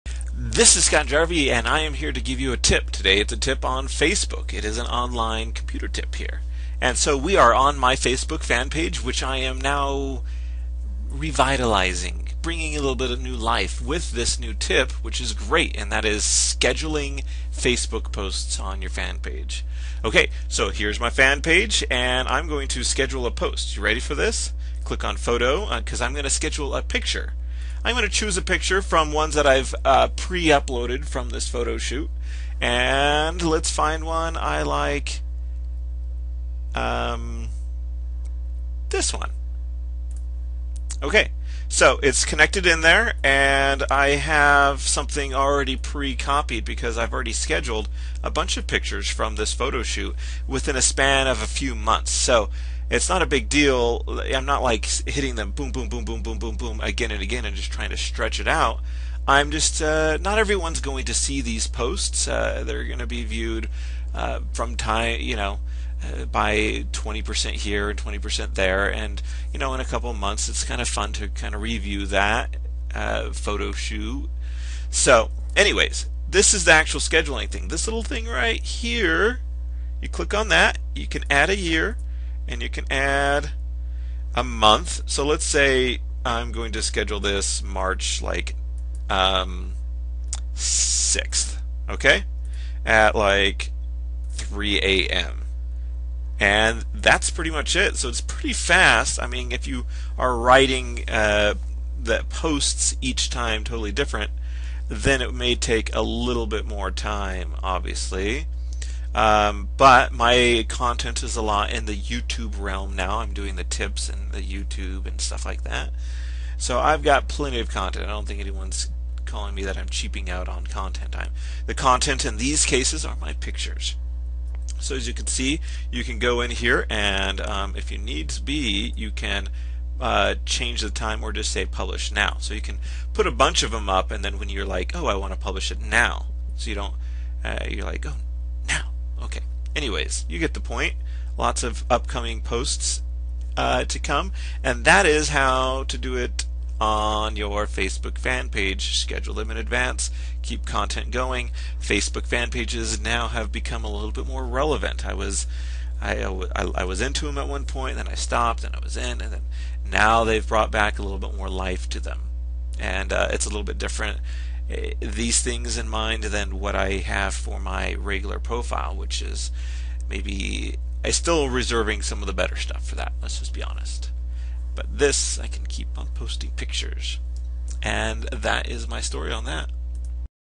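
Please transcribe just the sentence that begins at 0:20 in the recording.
Okay, so here's my fan page, and I'm going to schedule a post.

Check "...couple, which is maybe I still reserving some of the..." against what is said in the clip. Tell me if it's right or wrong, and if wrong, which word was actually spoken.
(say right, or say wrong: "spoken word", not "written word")
wrong: "profile", not "couple".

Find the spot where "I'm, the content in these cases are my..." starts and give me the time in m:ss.
2:01.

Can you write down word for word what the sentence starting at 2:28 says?
Schedule them in advance, keep content going.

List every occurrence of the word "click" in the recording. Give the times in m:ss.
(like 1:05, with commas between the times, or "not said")
0:24, 1:20.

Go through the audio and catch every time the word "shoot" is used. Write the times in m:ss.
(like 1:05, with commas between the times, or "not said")
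0:31, 0:49, 1:13.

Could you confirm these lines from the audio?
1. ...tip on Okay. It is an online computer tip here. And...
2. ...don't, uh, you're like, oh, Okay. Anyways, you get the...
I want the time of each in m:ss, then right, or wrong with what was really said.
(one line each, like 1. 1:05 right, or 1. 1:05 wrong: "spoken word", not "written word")
1. 0:03 wrong: "Facebook", not "Okay"
2. 2:16 right.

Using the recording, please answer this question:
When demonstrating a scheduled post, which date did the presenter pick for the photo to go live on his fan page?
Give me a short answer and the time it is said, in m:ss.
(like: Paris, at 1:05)
March 6th, at 1:27.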